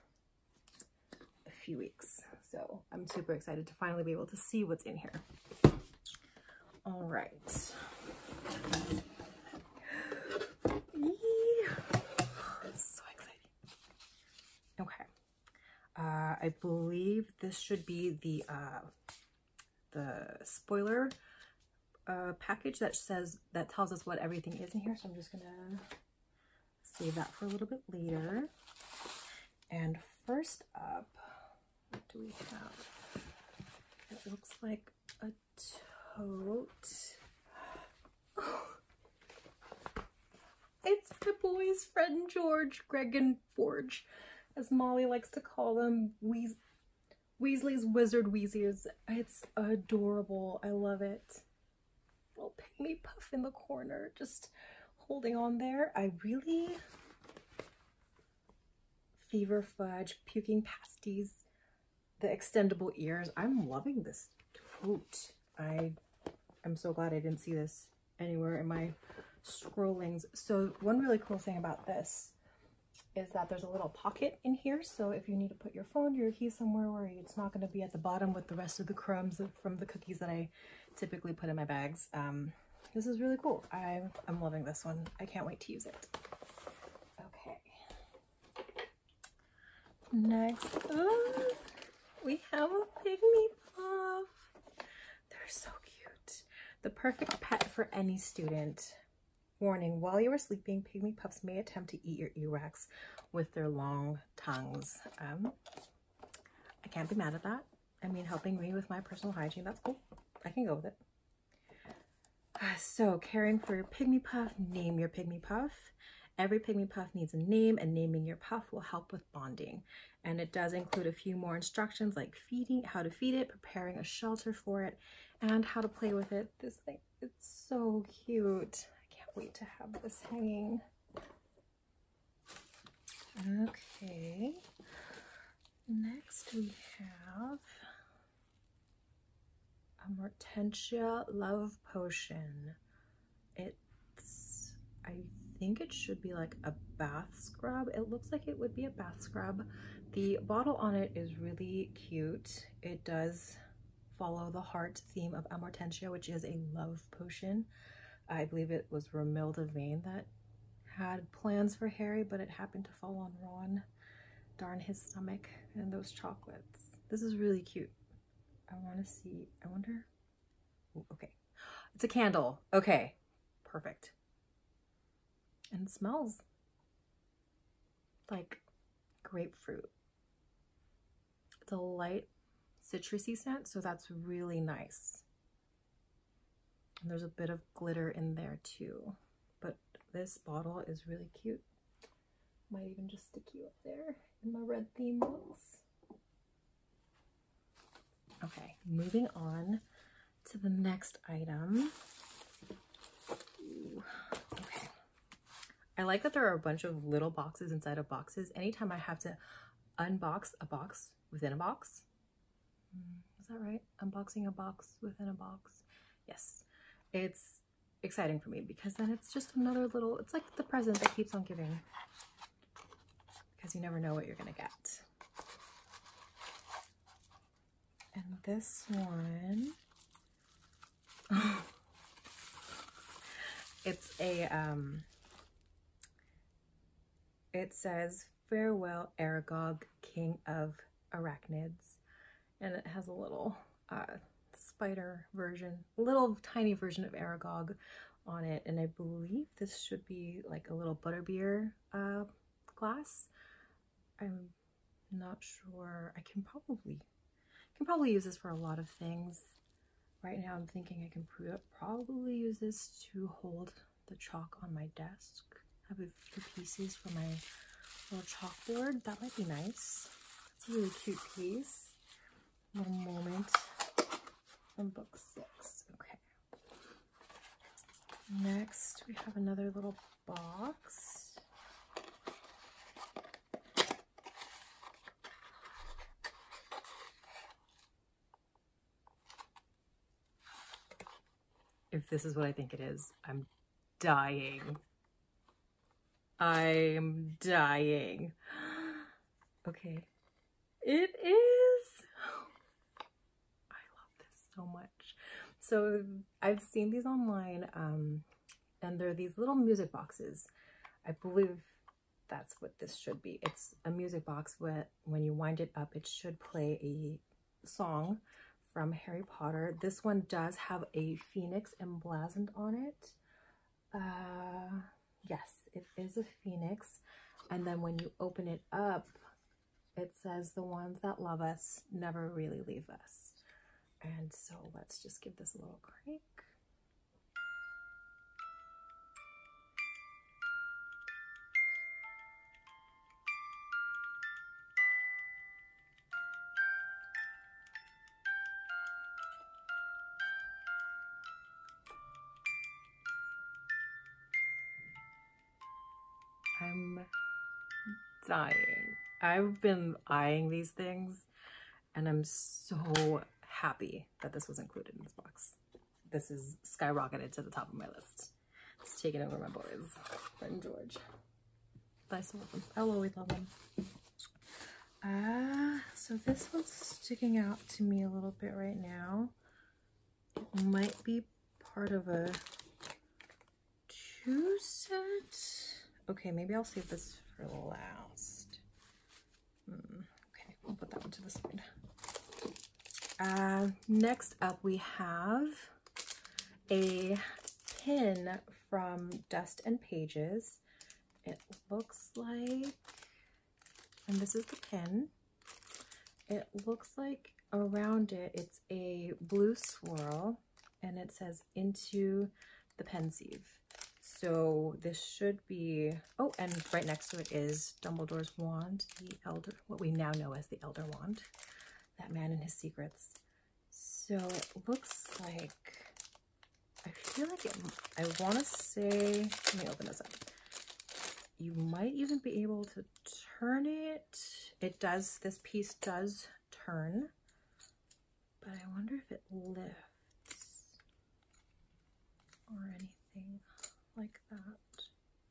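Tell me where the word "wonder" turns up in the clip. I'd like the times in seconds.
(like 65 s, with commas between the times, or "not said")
169 s, 438 s.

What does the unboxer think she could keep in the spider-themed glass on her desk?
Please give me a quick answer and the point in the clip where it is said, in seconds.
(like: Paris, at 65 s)
Chalk, at 264 s.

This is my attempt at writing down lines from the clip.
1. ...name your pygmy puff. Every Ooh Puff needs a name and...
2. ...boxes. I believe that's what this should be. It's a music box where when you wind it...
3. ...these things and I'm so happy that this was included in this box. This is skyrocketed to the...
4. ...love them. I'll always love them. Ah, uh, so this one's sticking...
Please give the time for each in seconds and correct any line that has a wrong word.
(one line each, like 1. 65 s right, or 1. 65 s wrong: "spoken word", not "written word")
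1. 114 s wrong: "Pygmy", not "Ooh"
2. 309 s right
3. 360 s right
4. 372 s right.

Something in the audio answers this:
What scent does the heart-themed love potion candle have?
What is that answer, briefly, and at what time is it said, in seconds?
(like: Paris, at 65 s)
Grapefruit, at 179 s.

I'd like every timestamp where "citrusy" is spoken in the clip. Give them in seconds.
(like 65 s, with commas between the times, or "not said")
182 s.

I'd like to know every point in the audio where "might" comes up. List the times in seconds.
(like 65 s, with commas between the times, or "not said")
192 s, 269 s, 380 s, 431 s.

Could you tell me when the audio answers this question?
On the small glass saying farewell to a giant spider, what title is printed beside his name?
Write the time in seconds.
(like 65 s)
240 s.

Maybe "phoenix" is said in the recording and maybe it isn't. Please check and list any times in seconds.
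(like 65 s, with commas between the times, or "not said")
321 s, 326 s.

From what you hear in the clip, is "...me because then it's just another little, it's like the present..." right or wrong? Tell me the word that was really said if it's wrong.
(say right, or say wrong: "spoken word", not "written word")
right.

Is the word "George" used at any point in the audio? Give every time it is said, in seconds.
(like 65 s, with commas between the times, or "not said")
42 s, 370 s.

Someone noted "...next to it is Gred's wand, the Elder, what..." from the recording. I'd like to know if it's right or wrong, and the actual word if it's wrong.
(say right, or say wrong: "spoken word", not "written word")
wrong: "Dumbledore", not "Gred".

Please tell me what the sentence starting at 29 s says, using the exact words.
And first up, do we have?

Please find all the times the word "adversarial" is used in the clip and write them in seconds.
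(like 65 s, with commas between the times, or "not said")
not said.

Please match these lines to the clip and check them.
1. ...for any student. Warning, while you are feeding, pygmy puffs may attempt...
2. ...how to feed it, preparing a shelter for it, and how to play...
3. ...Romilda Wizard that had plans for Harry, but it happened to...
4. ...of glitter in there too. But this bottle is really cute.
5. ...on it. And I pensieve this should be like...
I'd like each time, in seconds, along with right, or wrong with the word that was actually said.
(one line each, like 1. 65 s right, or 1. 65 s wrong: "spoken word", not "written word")
1. 97 s wrong: "sleeping", not "feeding"
2. 122 s right
3. 159 s wrong: "Vane", not "Wizard"
4. 187 s right
5. 248 s wrong: "believe", not "pensieve".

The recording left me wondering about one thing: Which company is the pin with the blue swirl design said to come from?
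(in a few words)
Dust and Pages.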